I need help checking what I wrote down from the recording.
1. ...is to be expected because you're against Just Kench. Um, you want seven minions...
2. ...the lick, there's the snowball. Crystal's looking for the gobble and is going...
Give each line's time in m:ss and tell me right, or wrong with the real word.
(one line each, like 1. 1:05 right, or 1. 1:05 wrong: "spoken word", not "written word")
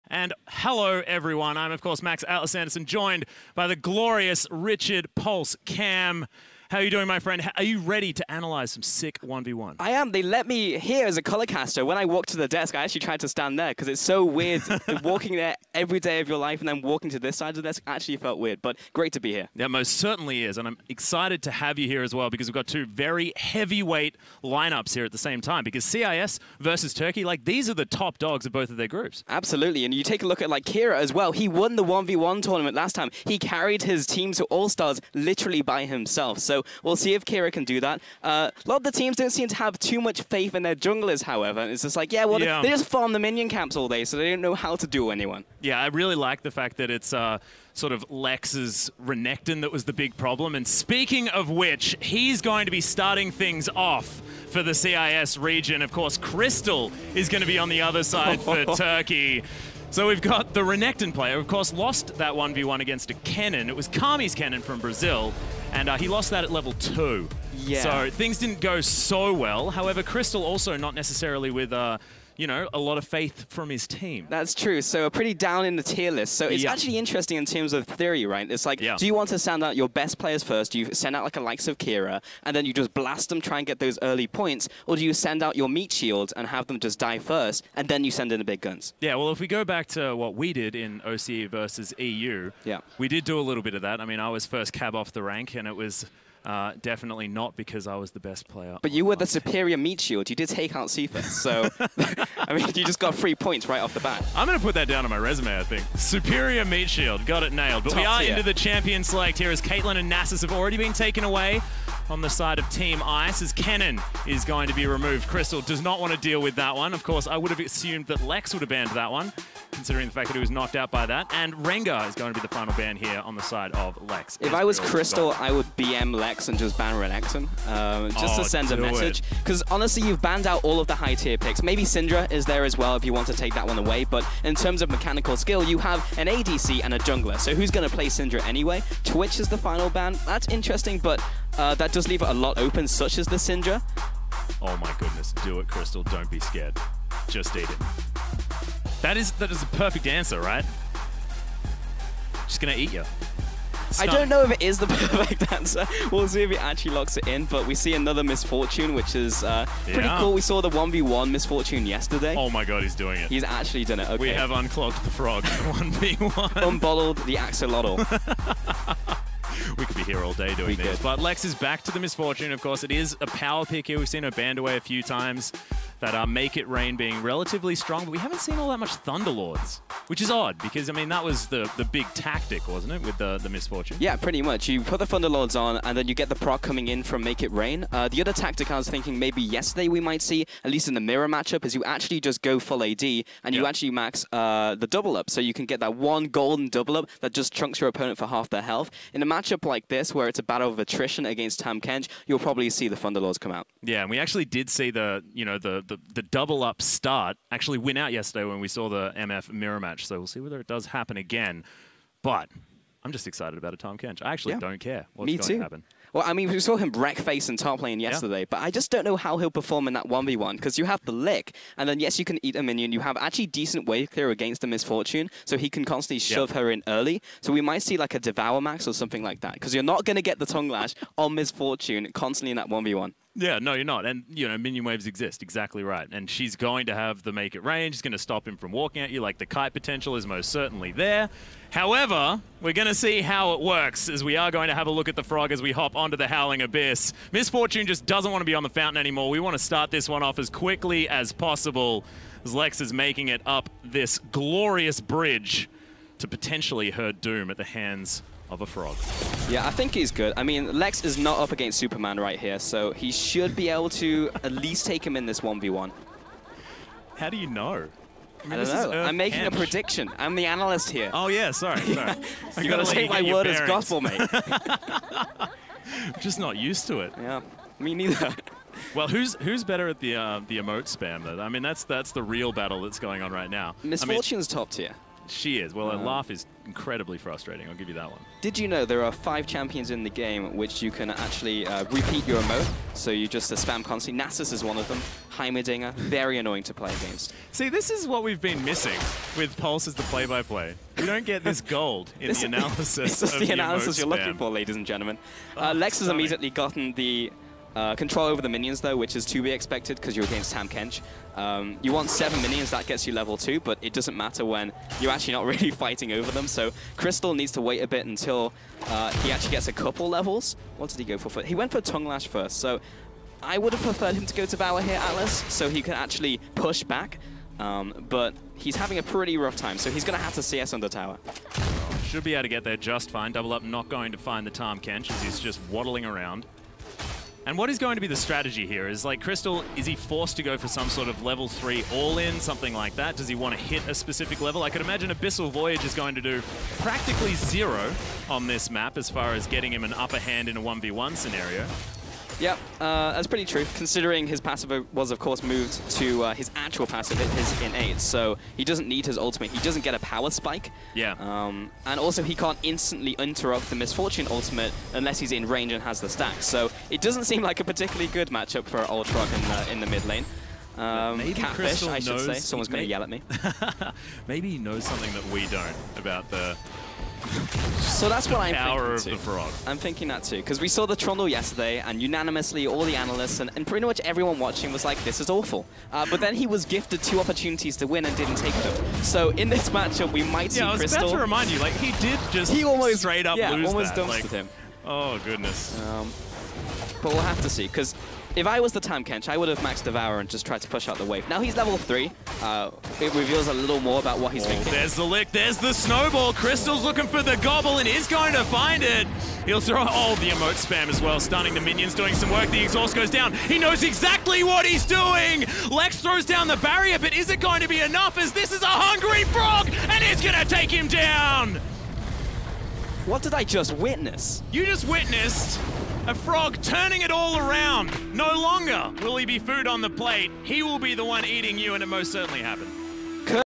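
1. 5:09 wrong: "Tahm", not "Just"
2. 6:44 right.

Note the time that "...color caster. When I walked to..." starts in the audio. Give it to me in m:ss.
0:11.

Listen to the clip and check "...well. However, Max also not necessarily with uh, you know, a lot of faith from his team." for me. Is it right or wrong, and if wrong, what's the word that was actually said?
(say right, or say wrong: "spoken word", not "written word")
wrong: "Crystal", not "Max".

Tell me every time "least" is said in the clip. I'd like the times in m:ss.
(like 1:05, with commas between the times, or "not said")
3:10, 4:24.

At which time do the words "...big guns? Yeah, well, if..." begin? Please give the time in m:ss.
1:28.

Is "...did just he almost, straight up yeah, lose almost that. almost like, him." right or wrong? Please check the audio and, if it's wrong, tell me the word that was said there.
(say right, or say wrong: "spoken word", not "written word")
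right.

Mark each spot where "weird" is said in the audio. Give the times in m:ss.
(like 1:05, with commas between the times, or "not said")
0:14, 0:18.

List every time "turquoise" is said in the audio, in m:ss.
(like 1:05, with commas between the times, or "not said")
not said.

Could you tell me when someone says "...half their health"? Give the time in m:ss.
3:18.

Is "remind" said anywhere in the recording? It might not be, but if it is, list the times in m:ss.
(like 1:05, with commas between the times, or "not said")
6:31.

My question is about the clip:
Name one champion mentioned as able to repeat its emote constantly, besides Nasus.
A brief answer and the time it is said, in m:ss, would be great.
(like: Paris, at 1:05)
Heimerdinger, at 4:55.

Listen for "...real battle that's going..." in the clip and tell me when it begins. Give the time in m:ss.
4:42.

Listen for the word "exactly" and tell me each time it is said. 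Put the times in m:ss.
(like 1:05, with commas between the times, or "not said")
3:55, 6:53.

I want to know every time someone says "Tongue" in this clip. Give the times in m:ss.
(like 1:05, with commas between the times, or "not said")
3:50, 5:21.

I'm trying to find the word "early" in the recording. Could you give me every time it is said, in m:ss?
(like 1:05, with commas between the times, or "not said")
1:24, 3:46.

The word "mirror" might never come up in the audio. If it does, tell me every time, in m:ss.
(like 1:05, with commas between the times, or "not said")
3:11, 3:29.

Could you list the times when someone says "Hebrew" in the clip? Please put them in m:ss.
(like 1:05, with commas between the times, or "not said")
not said.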